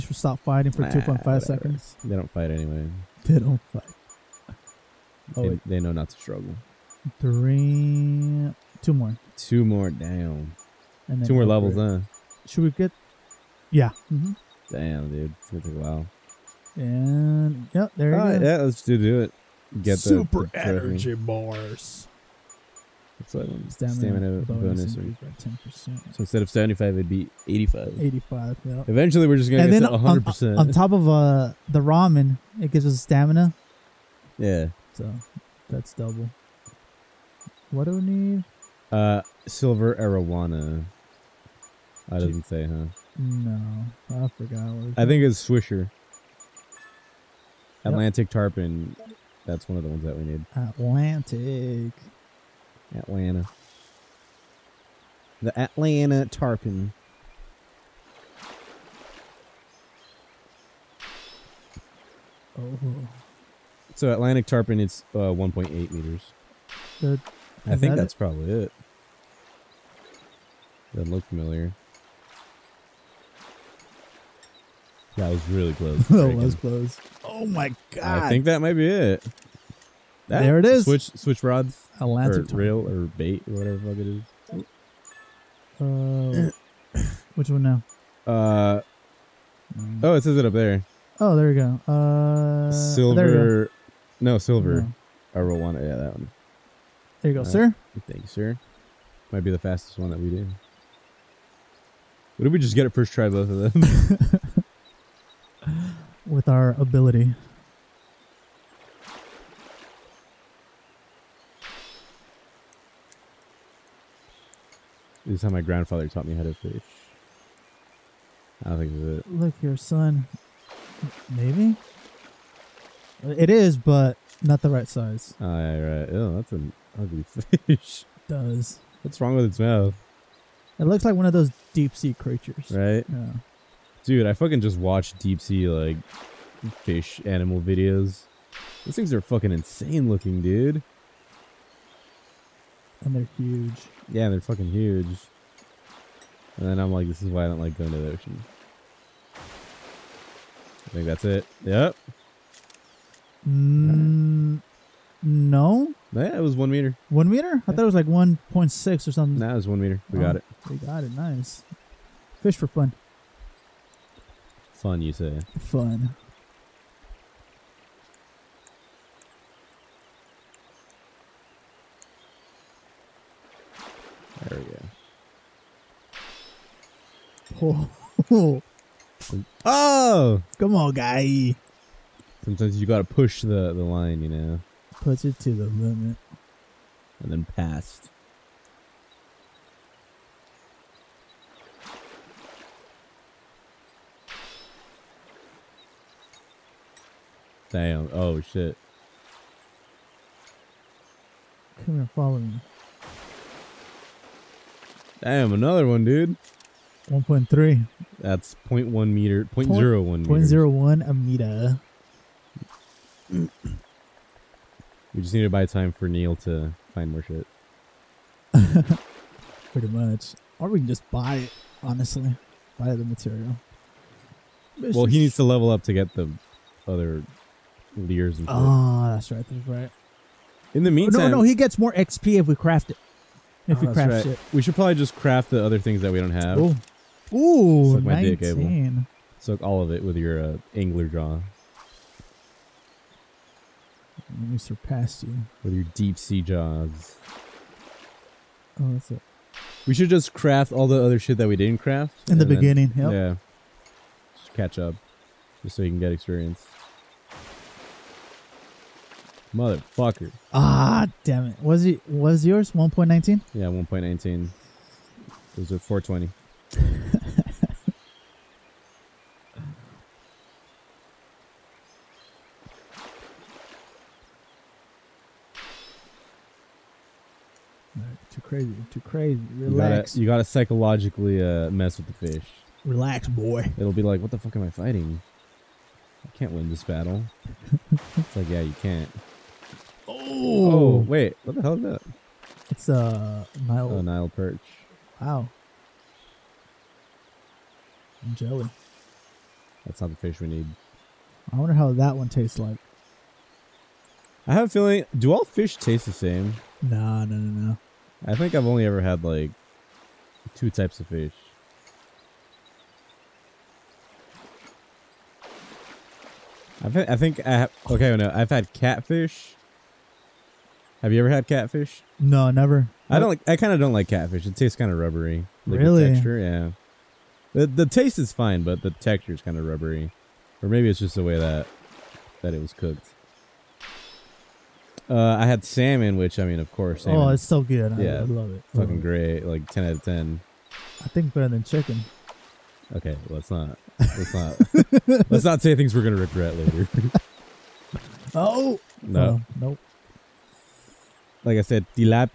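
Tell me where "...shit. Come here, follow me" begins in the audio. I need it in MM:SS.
03:18.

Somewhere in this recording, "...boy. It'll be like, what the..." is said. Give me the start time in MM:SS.
04:43.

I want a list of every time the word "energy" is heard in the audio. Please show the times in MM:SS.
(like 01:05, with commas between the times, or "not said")
00:20.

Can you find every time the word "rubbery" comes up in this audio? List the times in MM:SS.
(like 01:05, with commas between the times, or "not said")
05:24, 05:29.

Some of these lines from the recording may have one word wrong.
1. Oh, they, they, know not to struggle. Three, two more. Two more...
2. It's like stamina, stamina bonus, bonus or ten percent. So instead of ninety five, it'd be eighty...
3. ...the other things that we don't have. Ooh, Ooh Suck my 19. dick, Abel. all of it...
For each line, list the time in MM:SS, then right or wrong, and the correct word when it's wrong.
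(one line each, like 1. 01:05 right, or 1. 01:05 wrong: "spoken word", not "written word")
1. 00:05 right
2. 00:23 wrong: "seventy", not "ninety"
3. 03:55 right.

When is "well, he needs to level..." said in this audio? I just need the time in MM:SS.
03:44.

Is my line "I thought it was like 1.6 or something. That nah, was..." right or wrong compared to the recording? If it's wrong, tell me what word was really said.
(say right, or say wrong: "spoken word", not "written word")
right.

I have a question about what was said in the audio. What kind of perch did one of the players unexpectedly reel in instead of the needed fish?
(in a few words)
Nile perch.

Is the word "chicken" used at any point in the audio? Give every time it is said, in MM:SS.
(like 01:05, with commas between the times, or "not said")
05:41.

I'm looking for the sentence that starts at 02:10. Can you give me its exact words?
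It looks like one of those deep sea creatures.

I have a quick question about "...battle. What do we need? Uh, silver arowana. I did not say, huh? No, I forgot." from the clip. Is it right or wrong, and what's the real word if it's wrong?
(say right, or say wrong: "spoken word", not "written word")
wrong: "double", not "battle".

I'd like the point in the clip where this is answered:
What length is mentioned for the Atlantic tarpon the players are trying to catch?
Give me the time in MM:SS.
01:05.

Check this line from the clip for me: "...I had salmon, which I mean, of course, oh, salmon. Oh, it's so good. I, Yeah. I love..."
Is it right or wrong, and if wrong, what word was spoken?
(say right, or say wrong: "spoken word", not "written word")
right.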